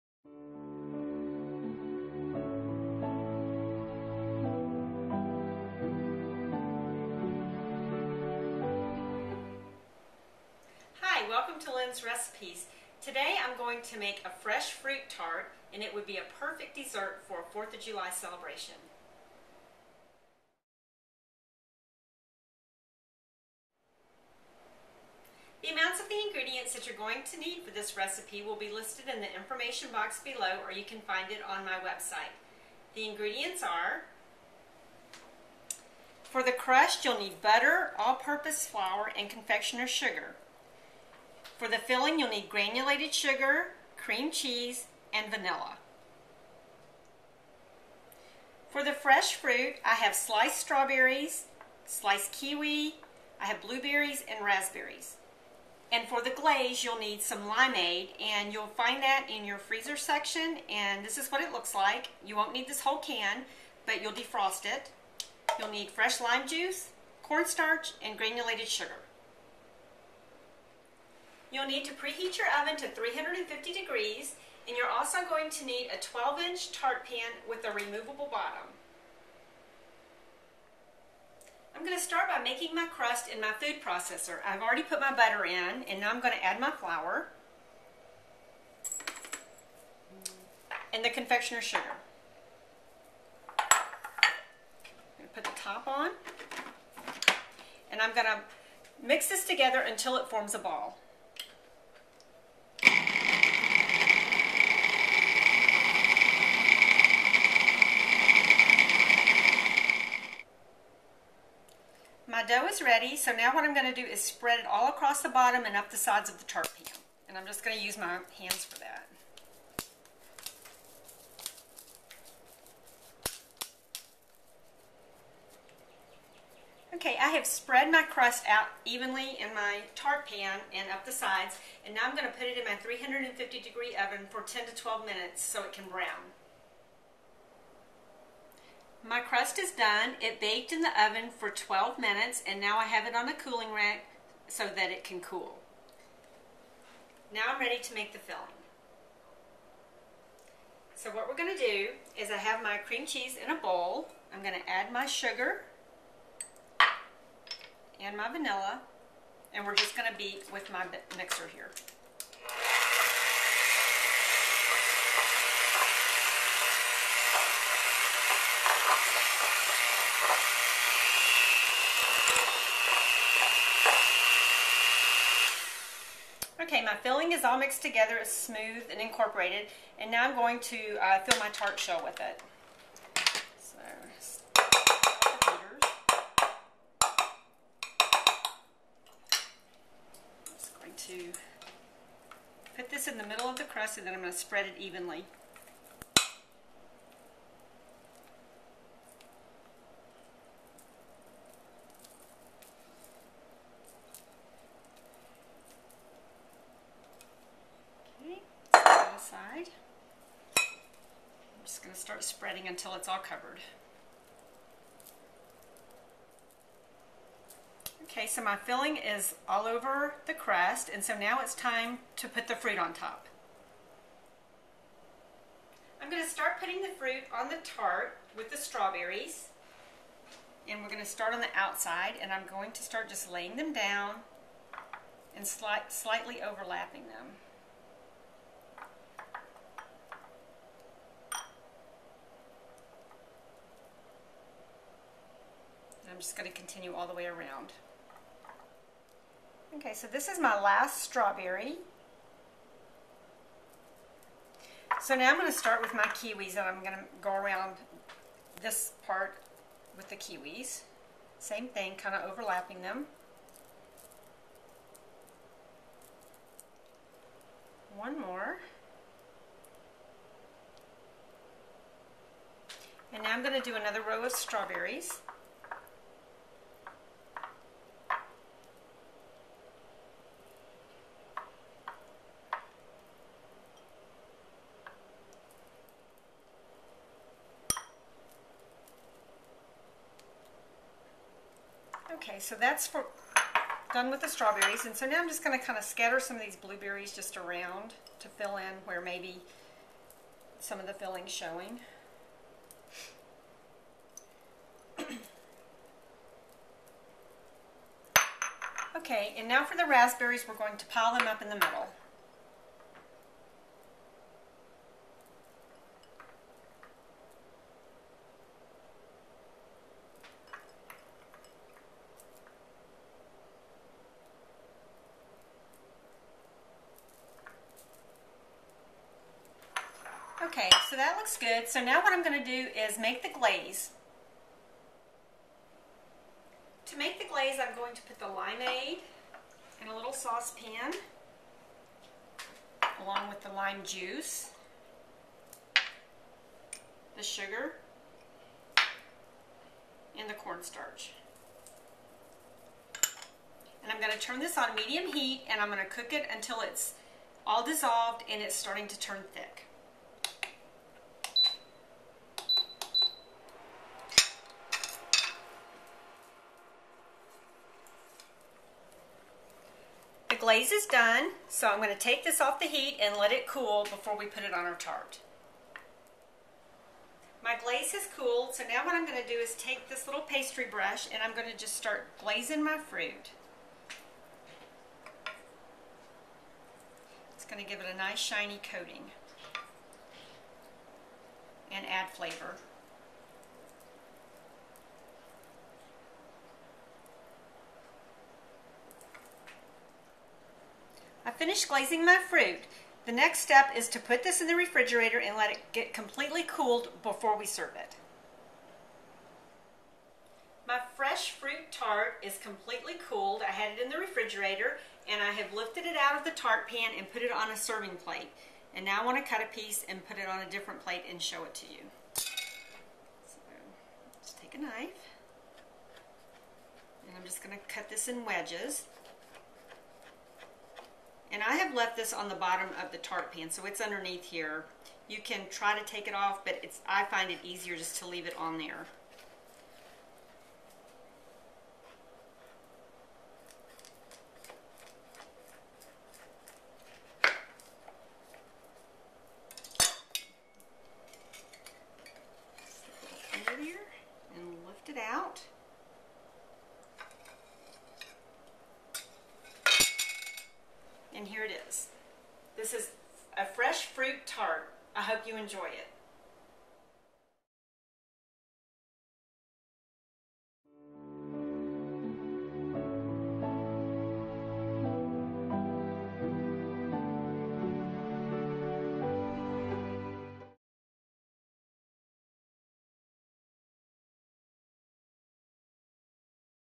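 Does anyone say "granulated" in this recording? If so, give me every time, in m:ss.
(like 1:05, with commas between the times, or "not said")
0:42, 1:08.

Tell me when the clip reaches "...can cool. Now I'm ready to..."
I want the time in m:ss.
2:25.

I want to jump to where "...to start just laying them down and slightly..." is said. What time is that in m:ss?
3:52.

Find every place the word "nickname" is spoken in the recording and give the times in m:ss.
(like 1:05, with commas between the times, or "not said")
not said.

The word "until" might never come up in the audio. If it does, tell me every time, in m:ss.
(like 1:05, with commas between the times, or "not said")
1:39, 3:32, 5:56.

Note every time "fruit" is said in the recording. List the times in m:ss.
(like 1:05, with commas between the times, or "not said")
0:14, 0:49, 3:42, 3:46, 6:22, 6:42, 6:51, 7:43.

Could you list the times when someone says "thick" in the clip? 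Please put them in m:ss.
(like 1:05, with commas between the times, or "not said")
5:59.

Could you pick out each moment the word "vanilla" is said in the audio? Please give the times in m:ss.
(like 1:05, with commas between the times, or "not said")
0:45, 2:38.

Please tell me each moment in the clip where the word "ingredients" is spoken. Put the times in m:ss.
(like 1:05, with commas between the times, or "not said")
0:26, 0:33.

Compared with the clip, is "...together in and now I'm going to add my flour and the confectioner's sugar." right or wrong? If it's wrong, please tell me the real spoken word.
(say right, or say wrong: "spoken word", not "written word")
wrong: "butter", not "together".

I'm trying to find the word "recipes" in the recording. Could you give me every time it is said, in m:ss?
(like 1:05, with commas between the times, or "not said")
0:12, 0:27.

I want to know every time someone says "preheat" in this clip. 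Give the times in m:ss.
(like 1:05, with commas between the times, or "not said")
1:11.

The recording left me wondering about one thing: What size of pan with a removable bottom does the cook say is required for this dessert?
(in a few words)
12 inch.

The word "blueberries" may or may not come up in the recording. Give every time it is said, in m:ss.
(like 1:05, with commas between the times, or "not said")
0:53, 4:56.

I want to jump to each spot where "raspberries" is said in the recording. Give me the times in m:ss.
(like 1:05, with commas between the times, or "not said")
0:54, 5:09.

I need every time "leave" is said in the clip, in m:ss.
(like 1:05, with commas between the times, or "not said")
7:18.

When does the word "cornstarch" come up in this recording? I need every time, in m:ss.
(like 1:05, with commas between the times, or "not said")
1:07, 5:50.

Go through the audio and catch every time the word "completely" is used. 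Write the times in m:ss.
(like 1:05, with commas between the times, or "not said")
6:45, 6:52.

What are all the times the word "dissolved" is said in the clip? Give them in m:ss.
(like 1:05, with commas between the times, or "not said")
5:57.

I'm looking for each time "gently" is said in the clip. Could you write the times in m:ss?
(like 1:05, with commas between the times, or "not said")
not said.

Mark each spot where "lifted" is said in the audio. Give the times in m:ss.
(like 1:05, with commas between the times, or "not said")
6:55.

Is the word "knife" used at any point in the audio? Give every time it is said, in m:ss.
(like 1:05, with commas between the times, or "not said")
7:04.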